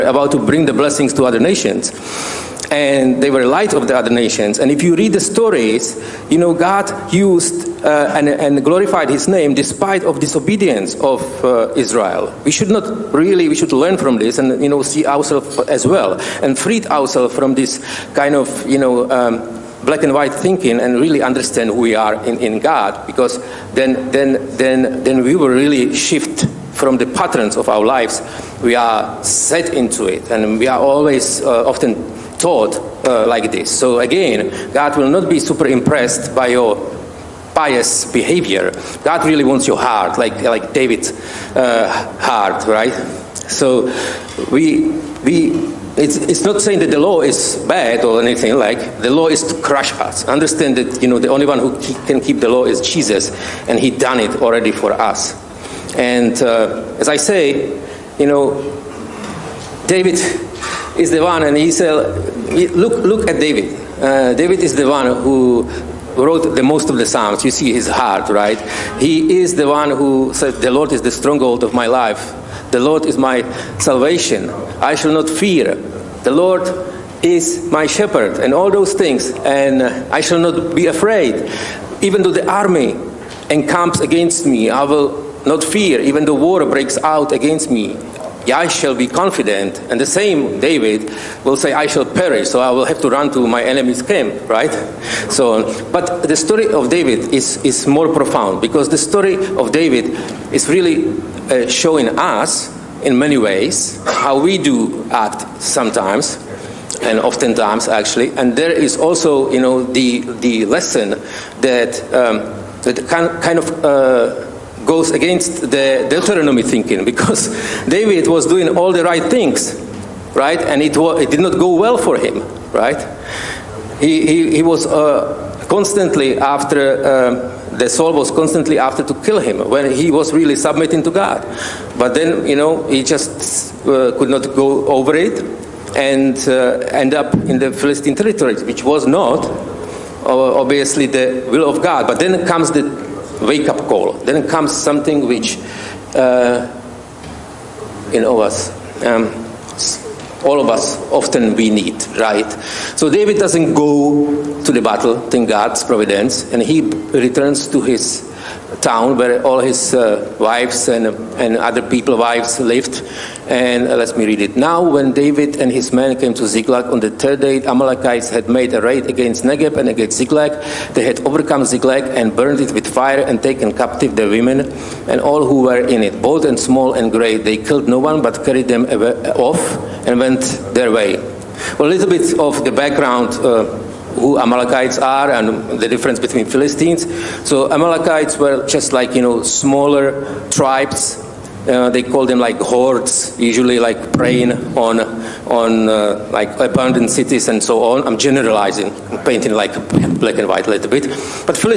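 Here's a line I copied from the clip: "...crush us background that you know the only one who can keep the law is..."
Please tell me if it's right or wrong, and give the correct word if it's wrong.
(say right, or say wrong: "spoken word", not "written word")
wrong: "understand", not "background".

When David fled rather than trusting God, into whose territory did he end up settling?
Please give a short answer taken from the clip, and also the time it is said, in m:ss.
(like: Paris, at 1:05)
Philistine territory, at 2:17.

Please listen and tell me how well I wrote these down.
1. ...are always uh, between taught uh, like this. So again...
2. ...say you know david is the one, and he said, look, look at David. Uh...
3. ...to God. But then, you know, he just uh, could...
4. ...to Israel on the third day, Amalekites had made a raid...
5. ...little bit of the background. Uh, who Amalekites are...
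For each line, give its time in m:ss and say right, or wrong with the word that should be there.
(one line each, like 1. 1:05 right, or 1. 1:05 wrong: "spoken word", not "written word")
1. 0:30 wrong: "often", not "between"
2. 0:57 right
3. 2:11 right
4. 2:46 wrong: "Ziklag", not "Israel"
5. 3:01 right.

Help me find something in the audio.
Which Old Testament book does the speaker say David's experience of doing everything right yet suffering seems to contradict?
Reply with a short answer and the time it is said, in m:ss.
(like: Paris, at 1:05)
Deuteronomy, at 1:56.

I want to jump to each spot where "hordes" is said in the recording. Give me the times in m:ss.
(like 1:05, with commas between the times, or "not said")
3:12.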